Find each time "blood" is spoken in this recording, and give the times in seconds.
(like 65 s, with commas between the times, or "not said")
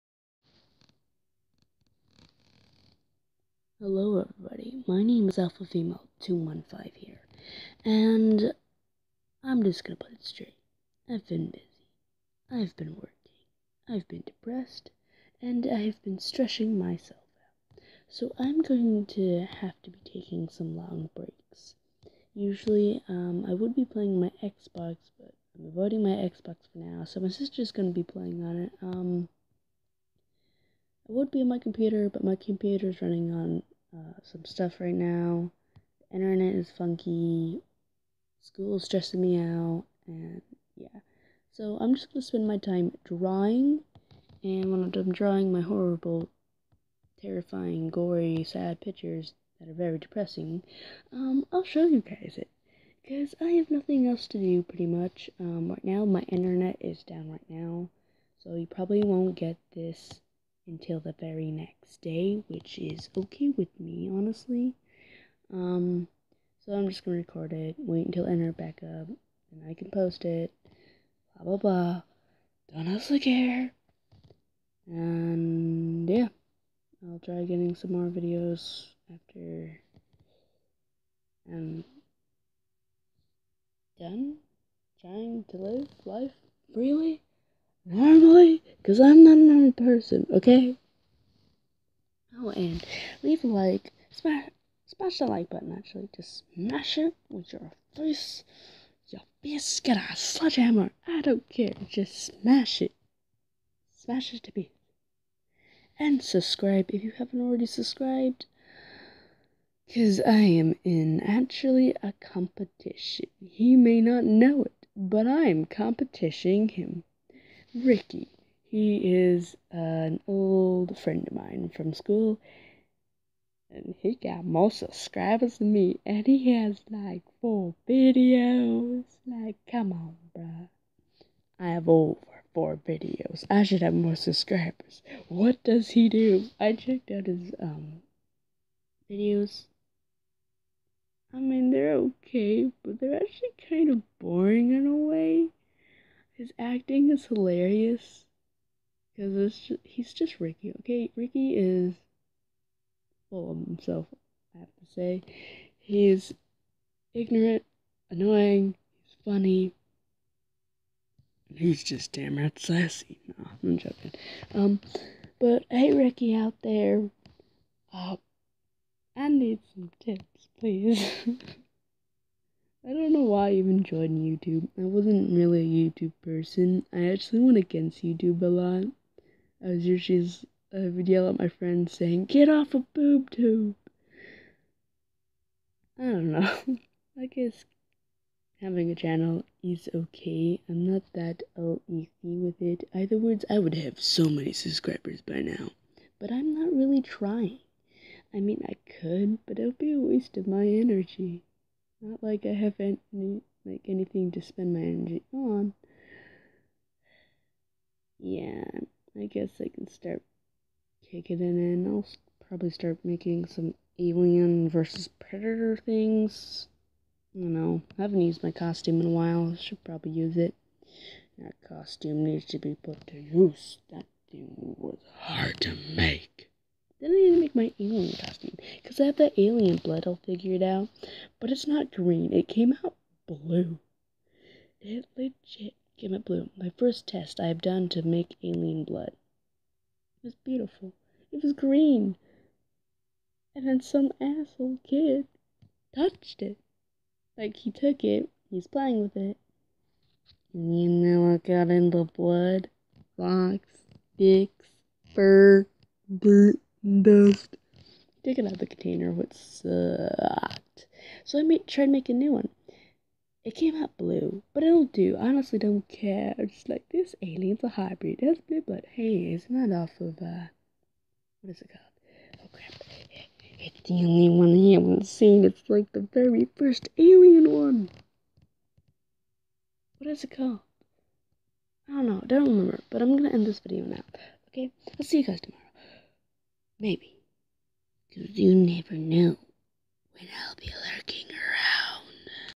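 229 s, 238 s, 252 s, 268 s.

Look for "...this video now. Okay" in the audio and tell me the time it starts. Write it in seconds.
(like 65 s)
283 s.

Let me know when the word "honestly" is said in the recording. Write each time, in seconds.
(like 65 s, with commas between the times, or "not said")
64 s, 265 s.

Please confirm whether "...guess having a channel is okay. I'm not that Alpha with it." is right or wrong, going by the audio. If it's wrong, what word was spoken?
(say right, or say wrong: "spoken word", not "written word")
wrong: "LEC", not "Alpha".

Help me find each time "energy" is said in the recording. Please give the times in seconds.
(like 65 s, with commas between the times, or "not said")
200 s, 204 s.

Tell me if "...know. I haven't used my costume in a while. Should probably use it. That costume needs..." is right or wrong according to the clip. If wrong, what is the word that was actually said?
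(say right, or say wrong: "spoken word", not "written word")
right.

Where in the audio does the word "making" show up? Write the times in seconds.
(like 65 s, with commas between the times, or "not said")
213 s, 261 s.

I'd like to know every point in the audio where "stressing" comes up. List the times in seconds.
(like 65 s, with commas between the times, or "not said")
16 s, 38 s.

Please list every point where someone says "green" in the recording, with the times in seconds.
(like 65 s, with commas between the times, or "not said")
231 s, 241 s.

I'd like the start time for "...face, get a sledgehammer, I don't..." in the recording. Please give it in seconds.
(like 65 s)
99 s.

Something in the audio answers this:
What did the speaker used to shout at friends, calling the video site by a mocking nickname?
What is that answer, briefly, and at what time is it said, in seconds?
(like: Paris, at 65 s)
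Boob tube, at 182 s.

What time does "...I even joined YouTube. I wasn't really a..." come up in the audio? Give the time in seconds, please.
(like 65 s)
173 s.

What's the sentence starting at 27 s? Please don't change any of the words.
So my sister's gonna be playing on it.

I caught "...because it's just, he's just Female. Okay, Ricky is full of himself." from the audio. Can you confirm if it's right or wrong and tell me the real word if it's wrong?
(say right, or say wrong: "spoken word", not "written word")
wrong: "Ricky", not "Female".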